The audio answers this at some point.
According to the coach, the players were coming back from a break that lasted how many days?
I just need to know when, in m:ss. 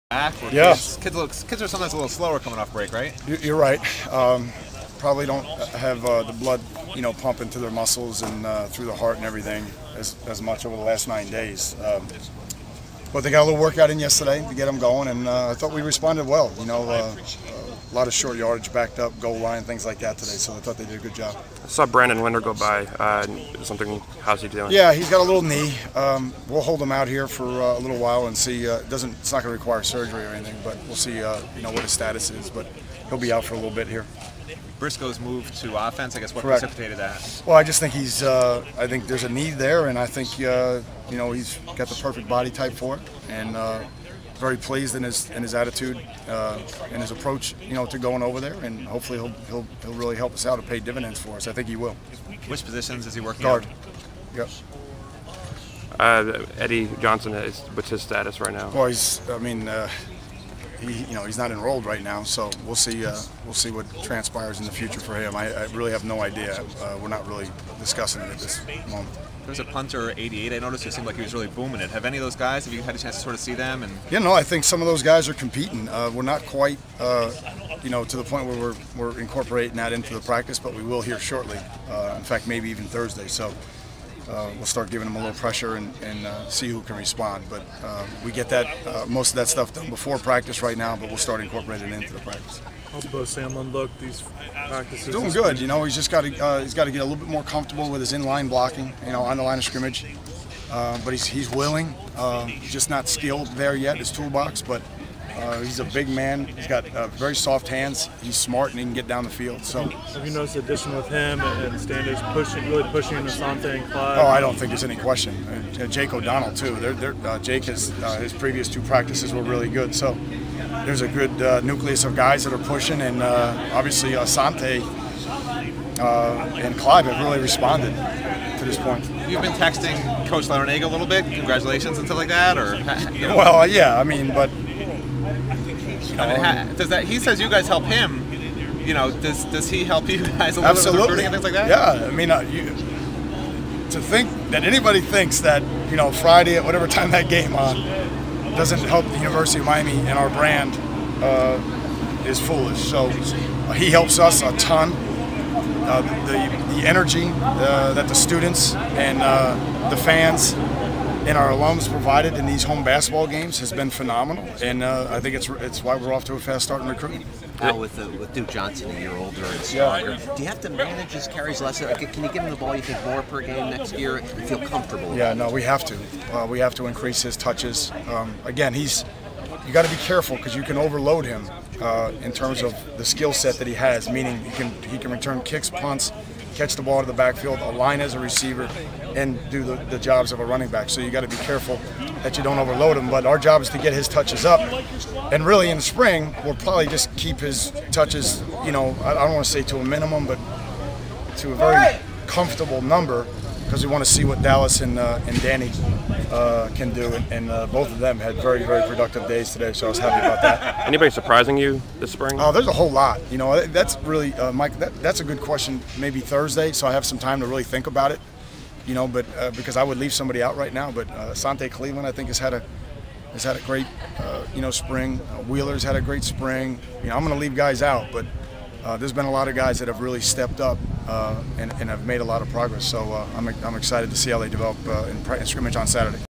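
0:11.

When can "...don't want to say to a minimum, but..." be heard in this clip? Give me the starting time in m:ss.
3:19.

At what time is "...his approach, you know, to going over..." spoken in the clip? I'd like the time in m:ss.
0:47.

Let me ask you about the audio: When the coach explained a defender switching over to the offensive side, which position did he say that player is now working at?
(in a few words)
Guard.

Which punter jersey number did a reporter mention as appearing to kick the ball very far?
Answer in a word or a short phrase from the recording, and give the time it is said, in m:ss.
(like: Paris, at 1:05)
88, at 1:10.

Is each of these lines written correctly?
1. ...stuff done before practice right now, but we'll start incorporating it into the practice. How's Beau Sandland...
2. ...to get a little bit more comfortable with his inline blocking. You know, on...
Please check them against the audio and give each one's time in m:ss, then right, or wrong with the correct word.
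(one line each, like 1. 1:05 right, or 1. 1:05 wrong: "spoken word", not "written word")
1. 1:29 right
2. 1:36 right.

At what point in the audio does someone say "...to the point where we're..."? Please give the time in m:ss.
1:18.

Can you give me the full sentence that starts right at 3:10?
So you got to be careful that you don't overload him.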